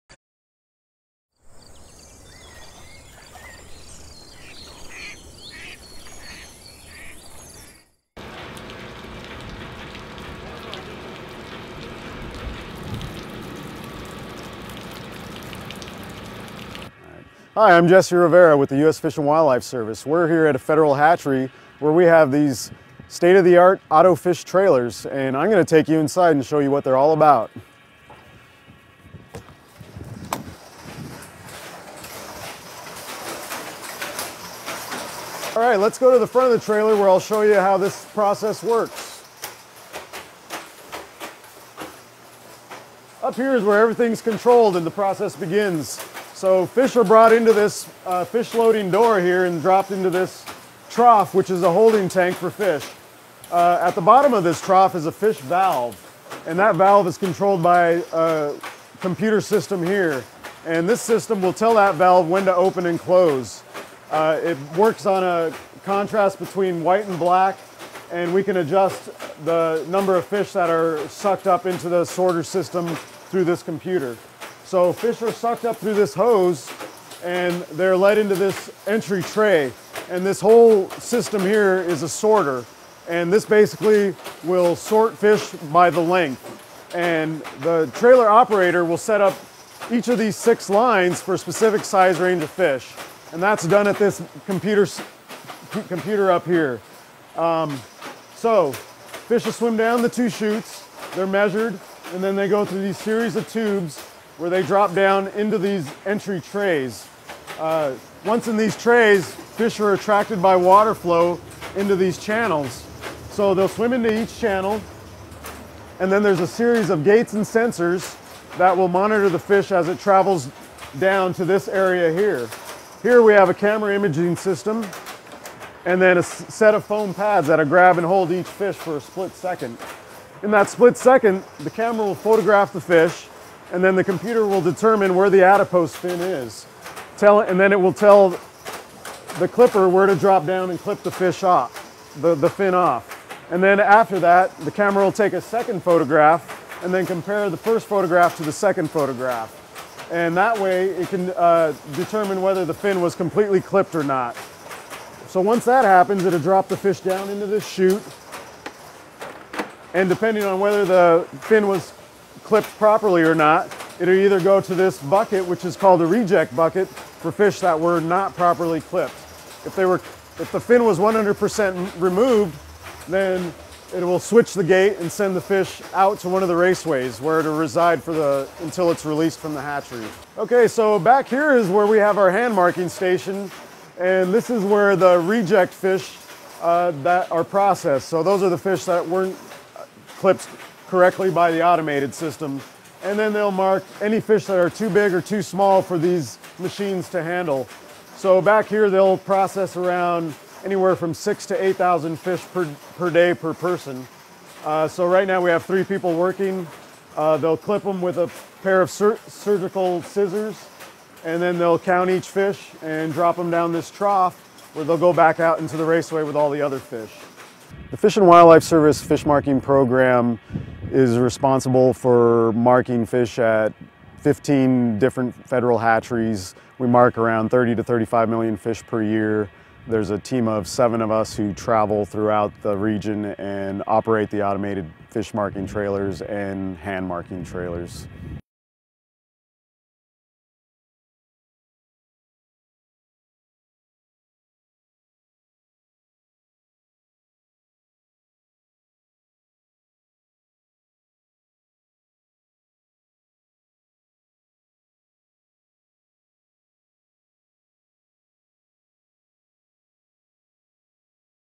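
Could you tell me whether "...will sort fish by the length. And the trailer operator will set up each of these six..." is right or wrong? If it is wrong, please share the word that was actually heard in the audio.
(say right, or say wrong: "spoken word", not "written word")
right.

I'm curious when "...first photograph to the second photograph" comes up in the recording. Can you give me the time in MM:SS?
02:27.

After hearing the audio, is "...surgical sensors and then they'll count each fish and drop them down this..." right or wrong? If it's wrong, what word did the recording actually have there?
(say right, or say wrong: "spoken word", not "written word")
wrong: "scissors", not "sensors".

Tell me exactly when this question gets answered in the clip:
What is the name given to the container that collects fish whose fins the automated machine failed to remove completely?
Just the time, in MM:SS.
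02:46.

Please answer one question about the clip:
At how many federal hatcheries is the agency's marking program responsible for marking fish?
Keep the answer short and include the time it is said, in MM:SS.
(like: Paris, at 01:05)
15, at 03:44.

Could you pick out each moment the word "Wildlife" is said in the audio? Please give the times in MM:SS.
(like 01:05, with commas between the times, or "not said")
00:19, 03:38.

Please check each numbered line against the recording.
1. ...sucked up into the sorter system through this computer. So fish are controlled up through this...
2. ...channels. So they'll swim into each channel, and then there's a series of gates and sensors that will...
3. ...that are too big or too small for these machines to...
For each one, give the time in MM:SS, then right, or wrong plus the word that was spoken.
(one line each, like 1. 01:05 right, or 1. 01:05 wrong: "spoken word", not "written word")
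1. 01:11 wrong: "sucked", not "controlled"
2. 01:52 right
3. 03:14 right.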